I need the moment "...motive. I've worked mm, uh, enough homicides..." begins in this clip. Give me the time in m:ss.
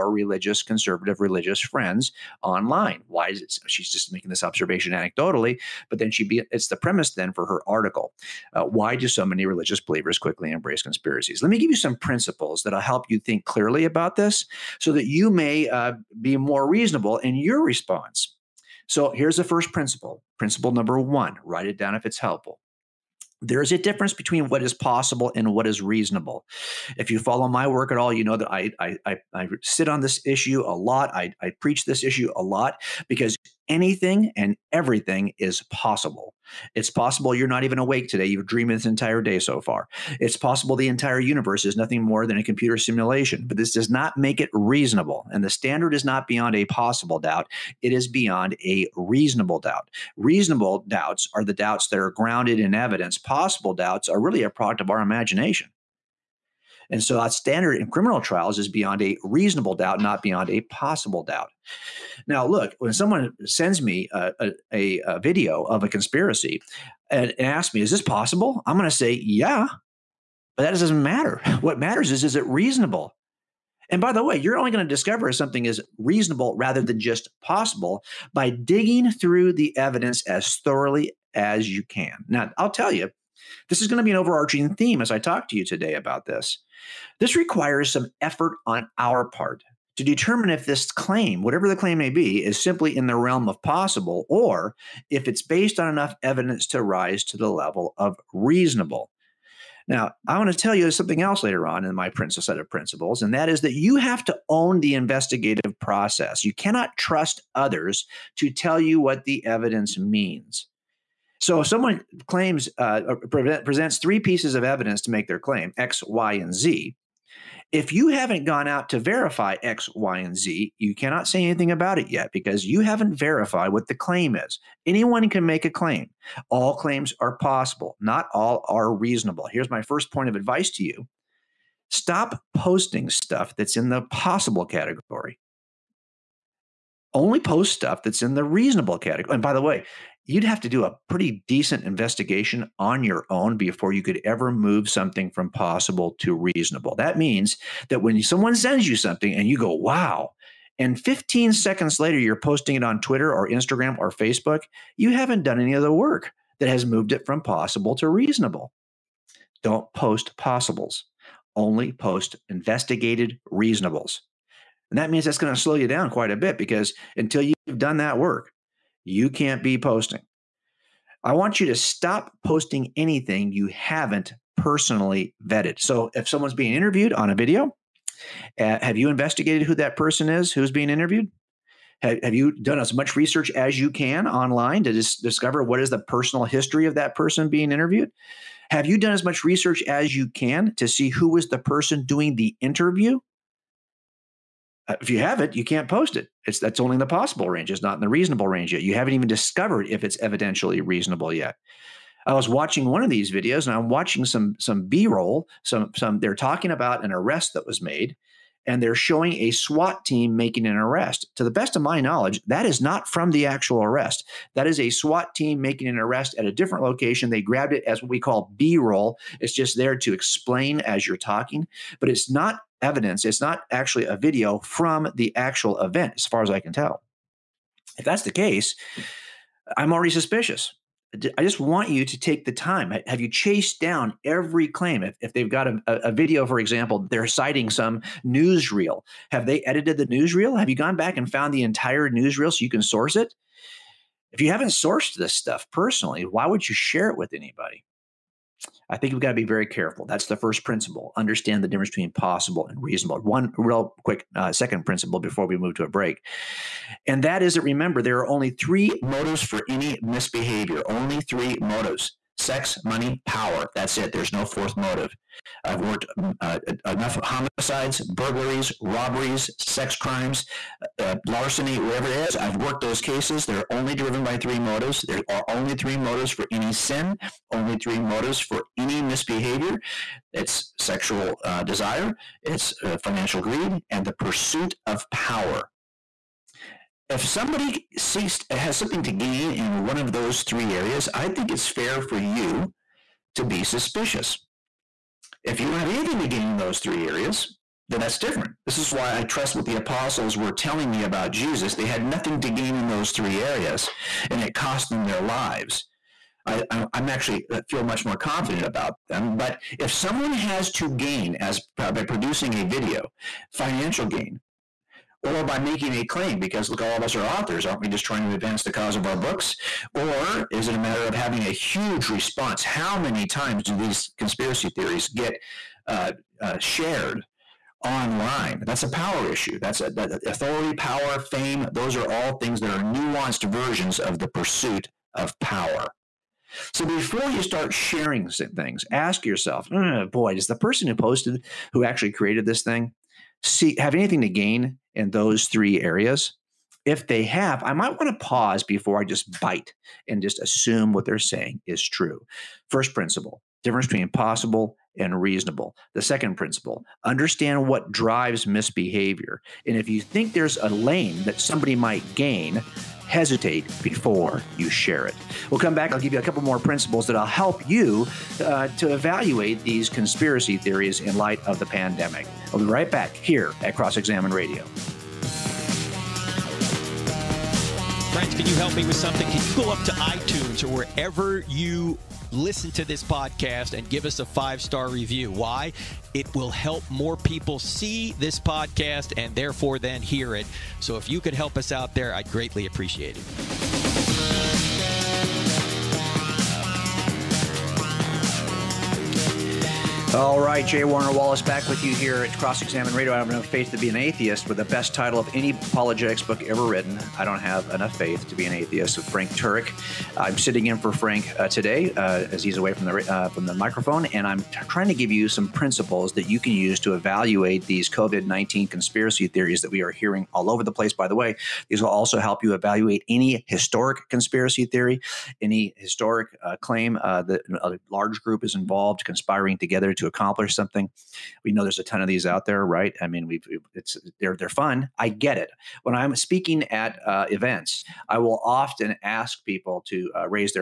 4:24.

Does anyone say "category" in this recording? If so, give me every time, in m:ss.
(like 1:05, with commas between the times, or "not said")
2:14, 2:18.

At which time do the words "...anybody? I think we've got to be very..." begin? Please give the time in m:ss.
4:07.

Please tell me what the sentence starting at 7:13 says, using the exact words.
I mean, we've it's they're they're fun.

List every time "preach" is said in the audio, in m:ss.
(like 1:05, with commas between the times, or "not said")
0:31.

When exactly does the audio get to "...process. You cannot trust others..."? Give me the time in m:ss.
1:45.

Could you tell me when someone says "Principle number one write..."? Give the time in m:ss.
0:20.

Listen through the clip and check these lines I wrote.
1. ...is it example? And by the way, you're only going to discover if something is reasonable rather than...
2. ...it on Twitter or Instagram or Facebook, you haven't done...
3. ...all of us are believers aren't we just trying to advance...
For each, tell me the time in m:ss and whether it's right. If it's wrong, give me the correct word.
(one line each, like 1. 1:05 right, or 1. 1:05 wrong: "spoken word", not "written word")
1. 1:12 wrong: "reasonable", not "example"
2. 2:32 right
3. 5:16 wrong: "authors", not "believers".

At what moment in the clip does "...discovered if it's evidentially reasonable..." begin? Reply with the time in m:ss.
3:19.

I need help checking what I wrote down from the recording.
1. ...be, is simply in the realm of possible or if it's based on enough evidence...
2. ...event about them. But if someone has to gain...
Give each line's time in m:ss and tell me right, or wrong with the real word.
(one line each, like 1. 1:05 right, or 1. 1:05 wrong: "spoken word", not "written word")
1. 1:32 right
2. 5:08 wrong: "confident", not "event".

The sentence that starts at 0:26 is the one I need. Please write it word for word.
If you follow my work at all, you know that I I, I, I sit on this issue a lot.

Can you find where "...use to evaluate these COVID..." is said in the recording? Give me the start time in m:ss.
6:56.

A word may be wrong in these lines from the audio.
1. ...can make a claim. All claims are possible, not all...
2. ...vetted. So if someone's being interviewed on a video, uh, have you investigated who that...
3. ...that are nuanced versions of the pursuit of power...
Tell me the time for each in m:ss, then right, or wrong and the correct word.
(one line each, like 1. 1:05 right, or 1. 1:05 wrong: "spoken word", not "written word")
1. 2:05 right
2. 2:55 right
3. 5:32 right.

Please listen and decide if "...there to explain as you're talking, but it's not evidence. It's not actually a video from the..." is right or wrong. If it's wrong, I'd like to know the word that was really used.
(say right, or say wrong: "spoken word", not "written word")
right.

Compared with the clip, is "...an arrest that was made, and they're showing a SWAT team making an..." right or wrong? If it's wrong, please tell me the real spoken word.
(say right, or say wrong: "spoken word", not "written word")
right.